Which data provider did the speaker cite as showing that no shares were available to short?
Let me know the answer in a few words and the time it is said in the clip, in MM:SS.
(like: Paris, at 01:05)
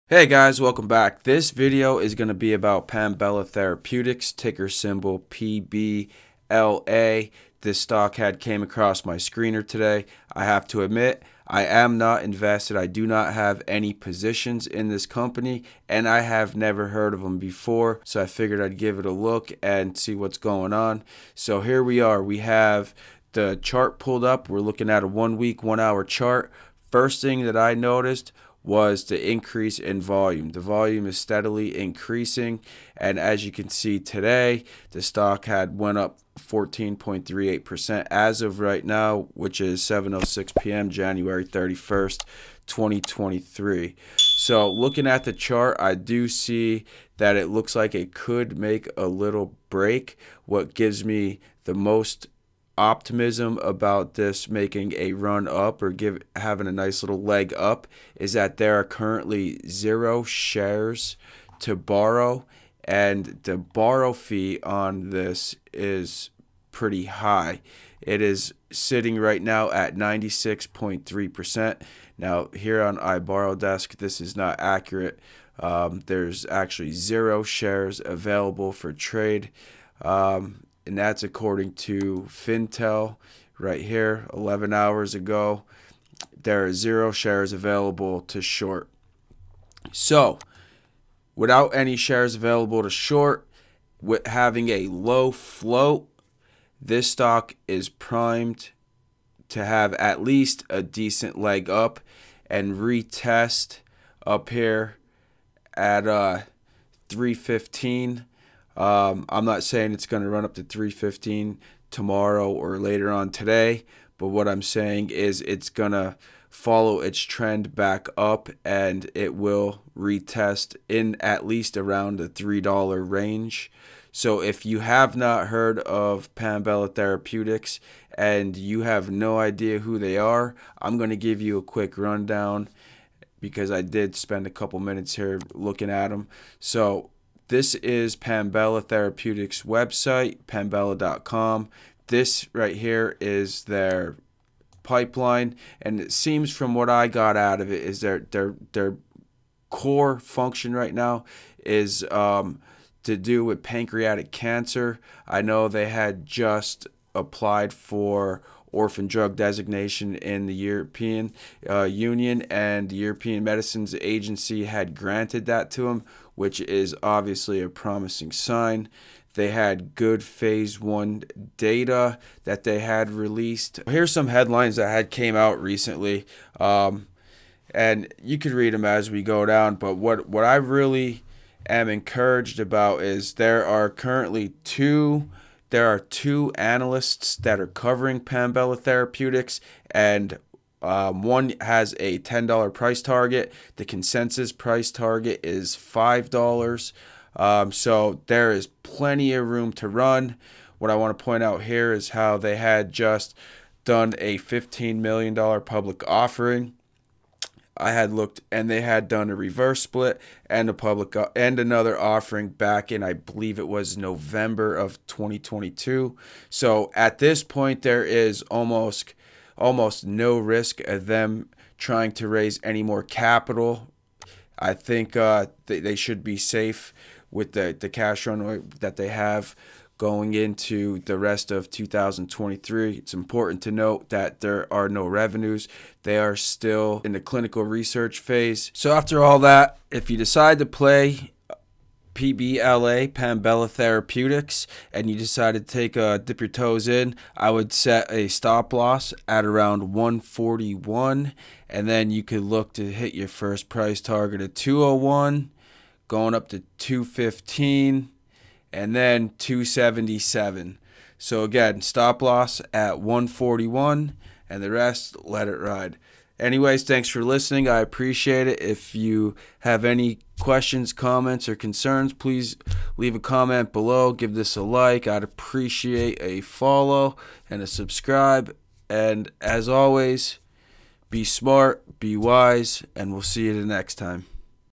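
Fintel, at 01:22.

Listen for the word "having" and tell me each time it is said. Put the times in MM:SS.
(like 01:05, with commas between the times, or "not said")
00:56, 01:34.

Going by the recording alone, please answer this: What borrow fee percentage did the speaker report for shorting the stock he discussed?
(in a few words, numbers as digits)
96.3%.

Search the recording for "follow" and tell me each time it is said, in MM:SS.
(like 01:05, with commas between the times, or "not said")
01:56, 04:36.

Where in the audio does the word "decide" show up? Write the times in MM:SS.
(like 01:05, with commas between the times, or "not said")
04:00, 04:05.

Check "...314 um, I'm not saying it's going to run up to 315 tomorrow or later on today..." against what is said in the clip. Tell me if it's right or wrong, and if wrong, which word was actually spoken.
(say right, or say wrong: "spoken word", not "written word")
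wrong: "315", not "314".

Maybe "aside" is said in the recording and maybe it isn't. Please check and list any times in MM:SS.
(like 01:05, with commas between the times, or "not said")
not said.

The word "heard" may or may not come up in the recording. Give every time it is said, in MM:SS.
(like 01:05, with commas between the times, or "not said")
00:16, 02:05.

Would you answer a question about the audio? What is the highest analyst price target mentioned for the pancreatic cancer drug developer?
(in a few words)
$10.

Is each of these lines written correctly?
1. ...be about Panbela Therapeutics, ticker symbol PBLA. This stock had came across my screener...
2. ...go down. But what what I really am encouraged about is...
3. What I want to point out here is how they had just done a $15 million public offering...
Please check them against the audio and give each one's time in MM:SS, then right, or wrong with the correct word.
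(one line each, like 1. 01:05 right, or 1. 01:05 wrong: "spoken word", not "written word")
1. 00:02 right
2. 02:59 right
3. 03:20 right.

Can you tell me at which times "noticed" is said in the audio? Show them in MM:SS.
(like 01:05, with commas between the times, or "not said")
00:27.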